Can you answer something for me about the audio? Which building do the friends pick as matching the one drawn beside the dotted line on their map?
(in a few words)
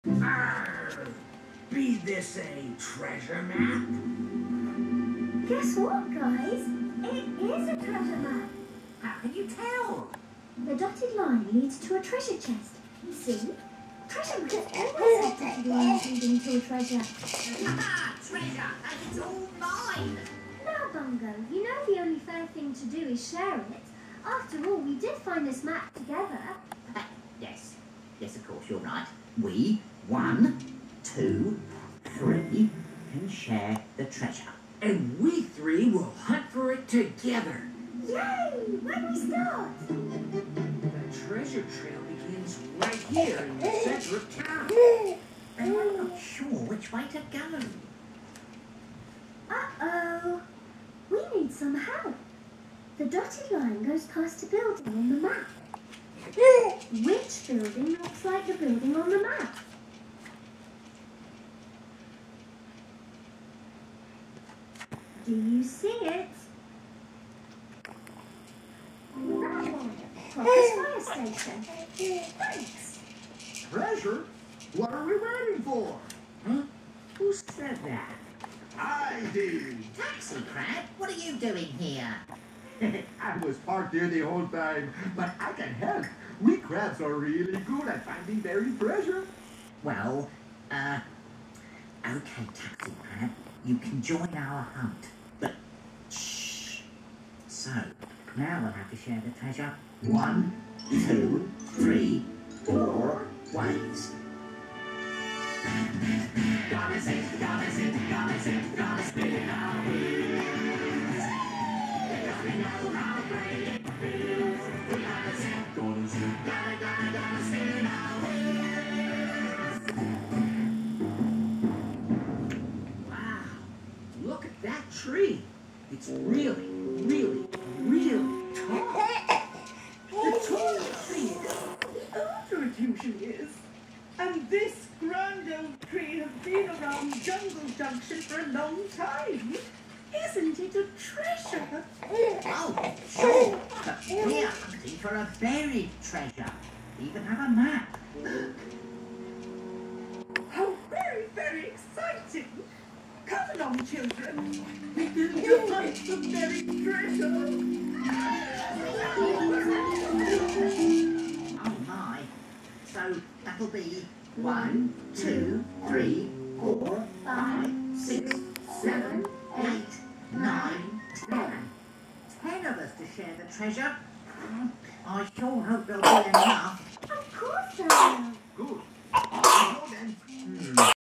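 Fire station.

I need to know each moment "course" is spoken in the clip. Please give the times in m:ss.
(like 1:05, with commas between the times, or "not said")
0:28.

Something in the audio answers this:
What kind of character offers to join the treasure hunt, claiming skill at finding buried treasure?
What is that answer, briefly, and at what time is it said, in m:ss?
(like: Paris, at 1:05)
Taxi crab, at 1:19.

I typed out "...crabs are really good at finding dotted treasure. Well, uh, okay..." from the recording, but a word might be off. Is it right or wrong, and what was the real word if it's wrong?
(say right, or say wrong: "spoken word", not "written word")
wrong: "buried", not "dotted".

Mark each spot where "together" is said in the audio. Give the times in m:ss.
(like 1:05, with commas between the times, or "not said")
0:25, 0:36.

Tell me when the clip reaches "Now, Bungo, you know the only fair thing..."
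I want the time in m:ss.
0:20.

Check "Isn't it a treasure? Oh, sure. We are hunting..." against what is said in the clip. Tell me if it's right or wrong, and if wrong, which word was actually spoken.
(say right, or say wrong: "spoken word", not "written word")
right.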